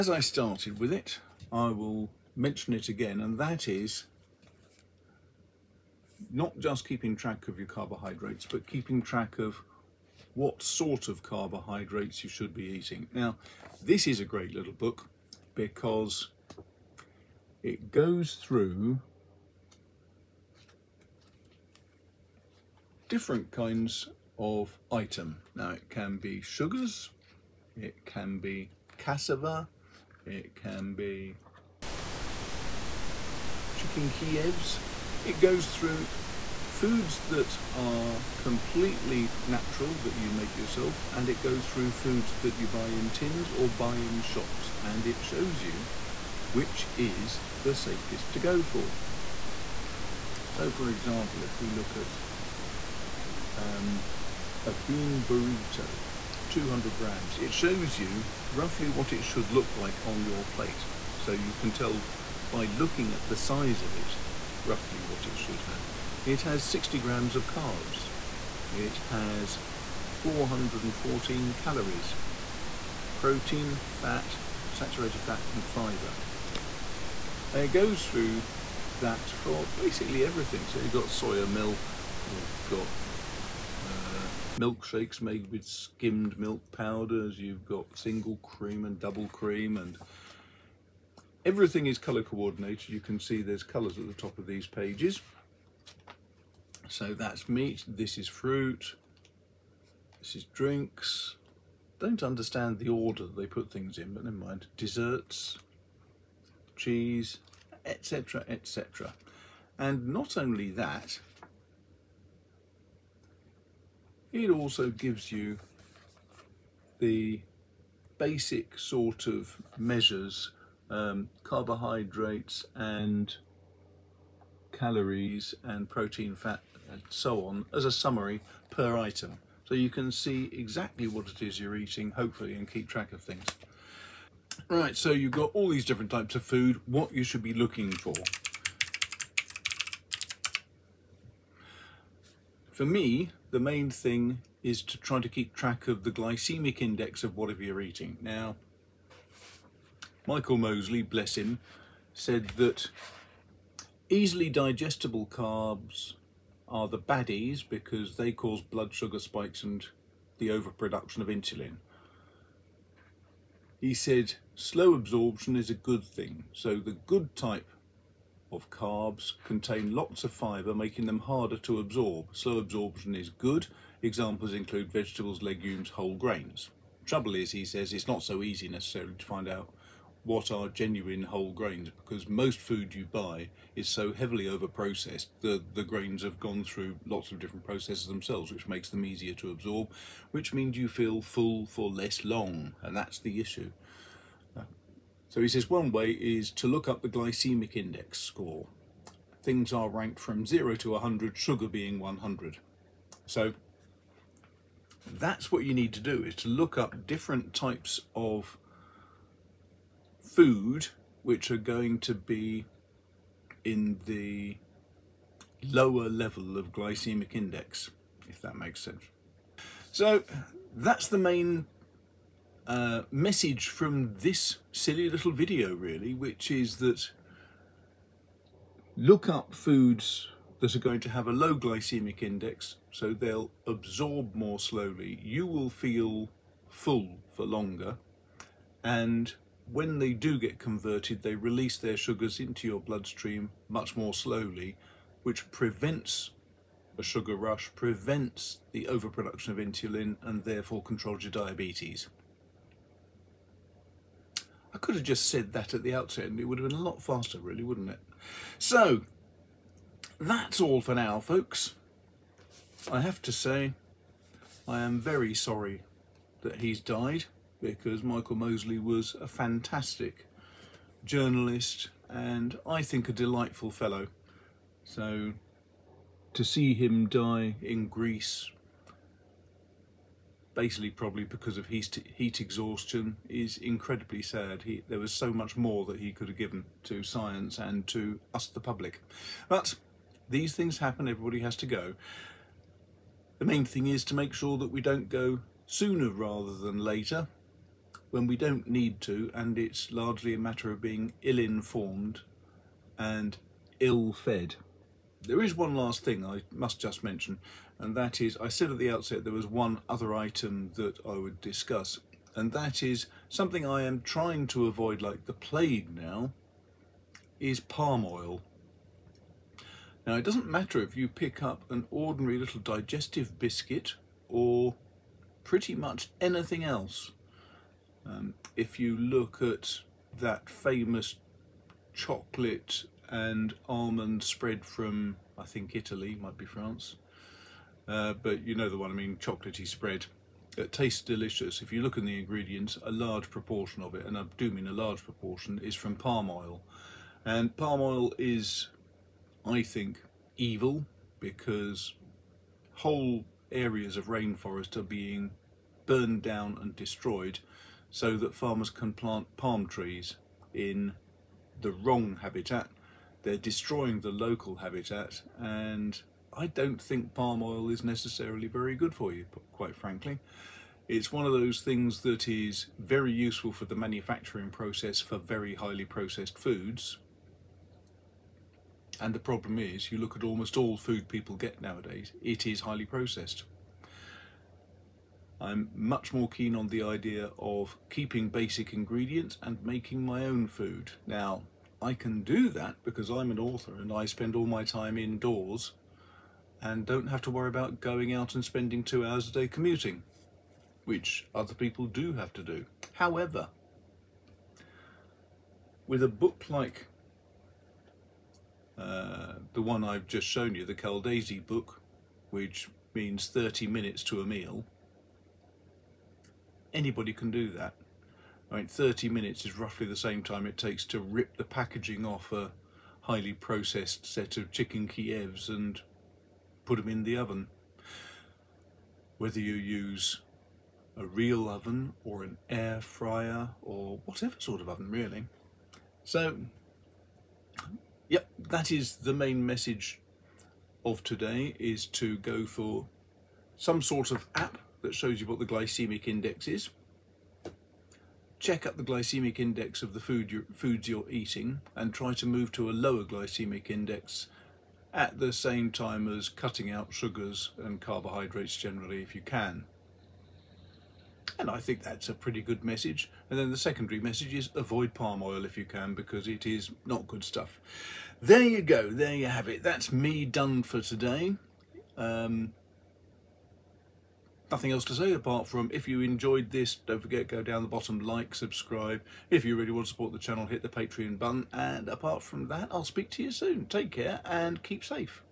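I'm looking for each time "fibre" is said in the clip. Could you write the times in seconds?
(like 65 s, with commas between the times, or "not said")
75 s, 170 s.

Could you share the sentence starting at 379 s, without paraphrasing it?
And the problem is, you look at almost all food people get nowadays, it is highly processed.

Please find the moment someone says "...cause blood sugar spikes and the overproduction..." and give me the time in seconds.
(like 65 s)
158 s.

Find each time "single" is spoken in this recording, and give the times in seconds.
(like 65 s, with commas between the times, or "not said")
87 s.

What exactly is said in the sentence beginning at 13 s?
Now, this is a great little book because it goes through different kinds of item.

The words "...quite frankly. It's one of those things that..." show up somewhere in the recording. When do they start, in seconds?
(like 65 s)
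369 s.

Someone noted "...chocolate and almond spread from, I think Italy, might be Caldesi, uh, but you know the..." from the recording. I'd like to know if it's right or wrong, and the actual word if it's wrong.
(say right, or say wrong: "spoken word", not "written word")
wrong: "France", not "Caldesi".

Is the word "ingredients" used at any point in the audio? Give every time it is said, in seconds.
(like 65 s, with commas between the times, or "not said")
342 s, 388 s.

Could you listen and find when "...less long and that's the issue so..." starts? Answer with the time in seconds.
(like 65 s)
191 s.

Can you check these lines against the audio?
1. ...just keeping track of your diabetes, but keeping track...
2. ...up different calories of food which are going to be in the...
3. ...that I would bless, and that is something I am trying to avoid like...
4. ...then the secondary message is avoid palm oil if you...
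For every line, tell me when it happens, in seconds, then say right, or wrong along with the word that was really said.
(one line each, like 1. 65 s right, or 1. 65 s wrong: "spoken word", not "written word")
1. 6 s wrong: "carbohydrates", not "diabetes"
2. 206 s wrong: "types", not "calories"
3. 310 s wrong: "discuss", not "bless"
4. 463 s right.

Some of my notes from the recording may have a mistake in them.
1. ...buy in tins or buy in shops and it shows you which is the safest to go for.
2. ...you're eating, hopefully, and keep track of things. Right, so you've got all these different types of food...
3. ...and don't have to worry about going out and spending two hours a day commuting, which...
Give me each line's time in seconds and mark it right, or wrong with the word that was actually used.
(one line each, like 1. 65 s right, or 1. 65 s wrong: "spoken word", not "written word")
1. 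42 s right
2. 131 s right
3. 396 s right.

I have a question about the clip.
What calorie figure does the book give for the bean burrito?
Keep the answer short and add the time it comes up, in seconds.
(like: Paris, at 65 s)
414, at 70 s.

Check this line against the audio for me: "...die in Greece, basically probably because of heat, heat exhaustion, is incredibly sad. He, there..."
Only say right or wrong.
right.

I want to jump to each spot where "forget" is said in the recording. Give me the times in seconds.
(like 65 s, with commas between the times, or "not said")
477 s.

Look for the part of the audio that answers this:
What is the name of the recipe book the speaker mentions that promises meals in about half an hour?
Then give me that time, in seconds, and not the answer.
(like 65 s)
410 s.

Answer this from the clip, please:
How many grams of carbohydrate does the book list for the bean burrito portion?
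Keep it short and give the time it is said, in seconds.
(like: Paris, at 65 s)
60 grams, at 66 s.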